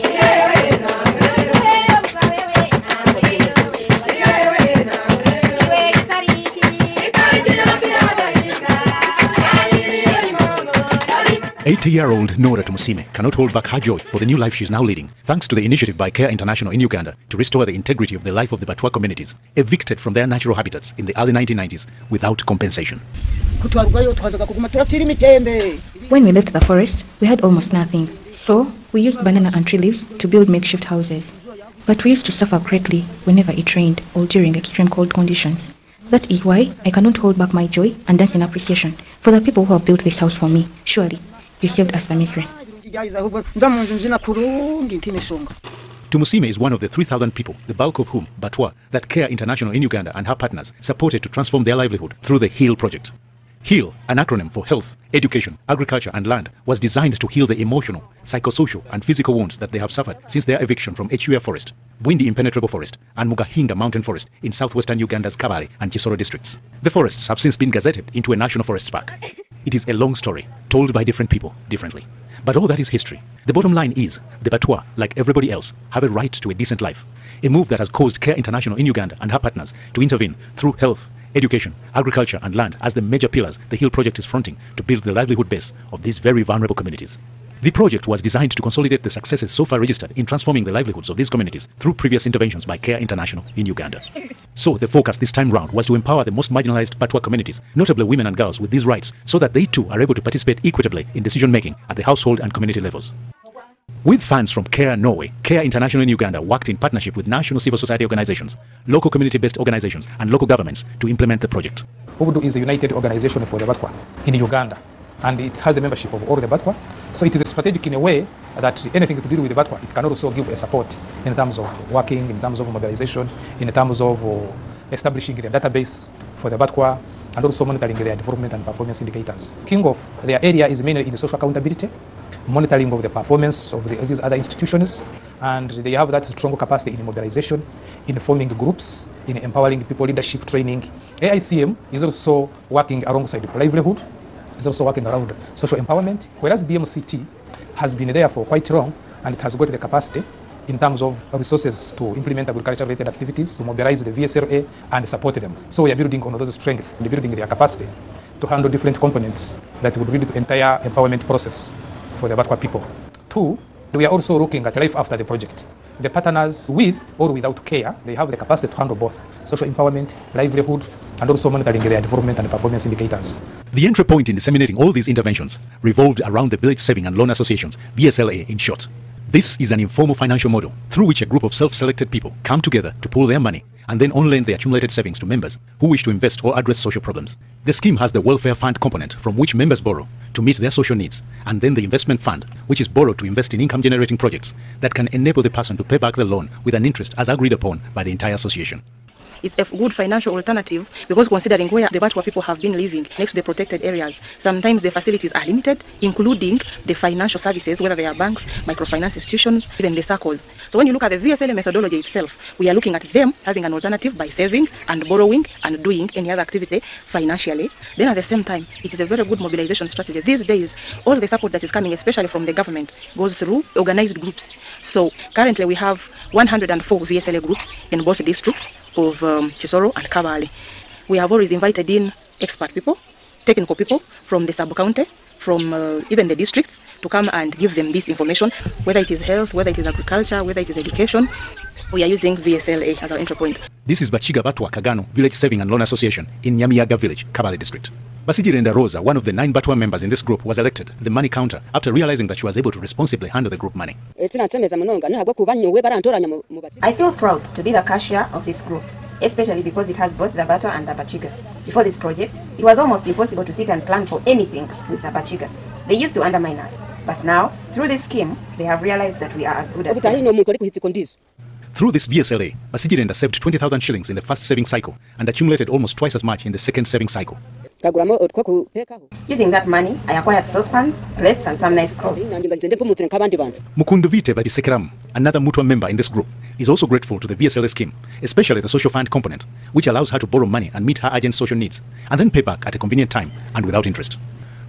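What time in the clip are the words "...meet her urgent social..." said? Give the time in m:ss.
4:50.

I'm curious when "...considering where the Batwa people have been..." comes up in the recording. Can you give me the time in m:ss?
3:21.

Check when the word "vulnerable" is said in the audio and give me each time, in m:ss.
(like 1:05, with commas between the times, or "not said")
1:26.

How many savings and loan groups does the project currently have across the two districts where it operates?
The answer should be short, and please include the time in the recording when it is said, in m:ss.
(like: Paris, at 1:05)
104, at 3:46.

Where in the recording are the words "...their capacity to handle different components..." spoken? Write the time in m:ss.
2:37.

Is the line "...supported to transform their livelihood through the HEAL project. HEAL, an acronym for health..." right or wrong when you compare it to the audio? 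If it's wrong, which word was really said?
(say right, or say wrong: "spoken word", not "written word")
right.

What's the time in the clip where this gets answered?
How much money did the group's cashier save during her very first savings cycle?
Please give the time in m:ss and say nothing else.
4:33.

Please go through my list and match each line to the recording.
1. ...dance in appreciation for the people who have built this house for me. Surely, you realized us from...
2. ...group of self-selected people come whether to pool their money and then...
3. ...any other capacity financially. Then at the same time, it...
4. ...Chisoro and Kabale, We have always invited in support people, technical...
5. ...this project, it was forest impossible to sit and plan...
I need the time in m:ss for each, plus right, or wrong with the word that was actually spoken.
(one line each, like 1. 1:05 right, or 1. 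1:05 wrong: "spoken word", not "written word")
1. 0:38 wrong: "saved", not "realized"
2. 3:01 wrong: "together", not "whether"
3. 3:36 wrong: "activity", not "capacity"
4. 3:49 wrong: "expert", not "support"
5. 4:21 wrong: "almost", not "forest".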